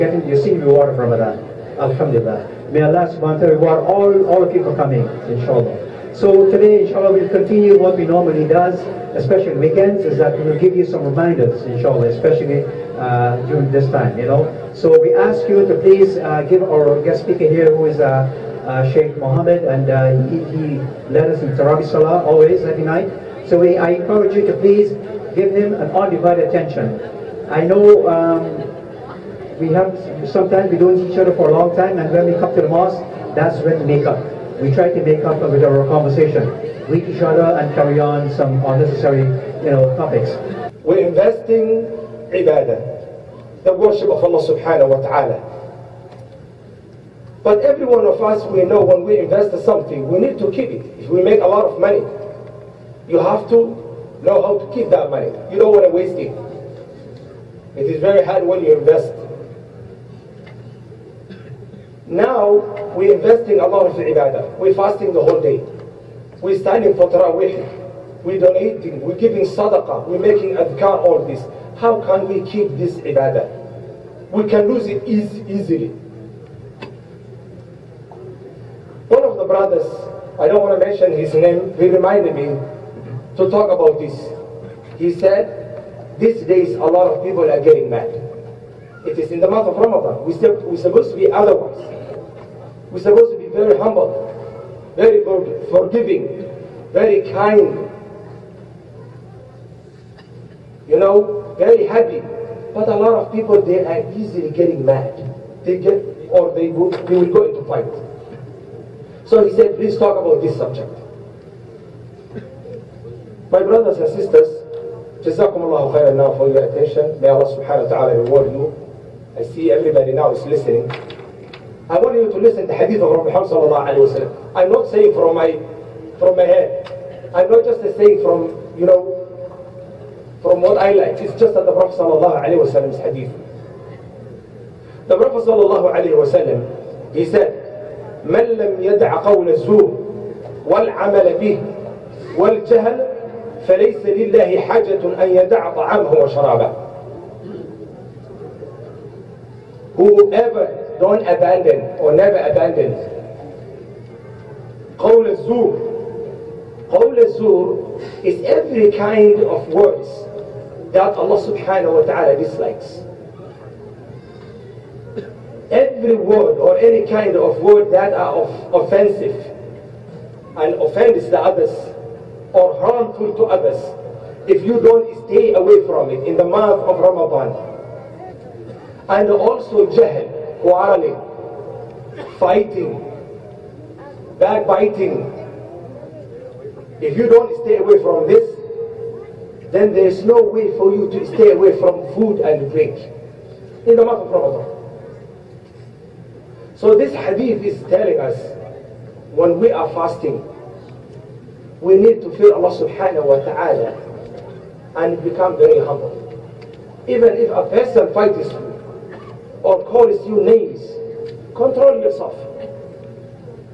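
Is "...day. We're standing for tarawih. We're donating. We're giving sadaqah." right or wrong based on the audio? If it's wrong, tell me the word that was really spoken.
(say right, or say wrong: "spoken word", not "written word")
right.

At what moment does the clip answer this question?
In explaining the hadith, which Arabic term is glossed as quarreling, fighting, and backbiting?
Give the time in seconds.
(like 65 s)
179 s.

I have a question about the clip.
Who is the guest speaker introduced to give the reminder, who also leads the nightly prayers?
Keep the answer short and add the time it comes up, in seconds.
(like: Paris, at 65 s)
Sheikh Mohammed, at 18 s.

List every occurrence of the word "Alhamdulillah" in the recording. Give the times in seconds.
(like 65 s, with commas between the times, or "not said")
1 s.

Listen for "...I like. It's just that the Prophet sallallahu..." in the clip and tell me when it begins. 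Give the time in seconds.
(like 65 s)
130 s.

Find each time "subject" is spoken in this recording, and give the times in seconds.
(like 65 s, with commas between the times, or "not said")
110 s.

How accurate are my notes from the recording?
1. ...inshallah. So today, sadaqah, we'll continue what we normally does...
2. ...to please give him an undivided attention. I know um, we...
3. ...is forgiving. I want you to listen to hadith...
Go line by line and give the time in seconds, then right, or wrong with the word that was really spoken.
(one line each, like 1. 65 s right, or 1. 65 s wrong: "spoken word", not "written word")
1. 5 s wrong: "inshallah", not "sadaqah"
2. 24 s right
3. 120 s wrong: "listening", not "forgiving".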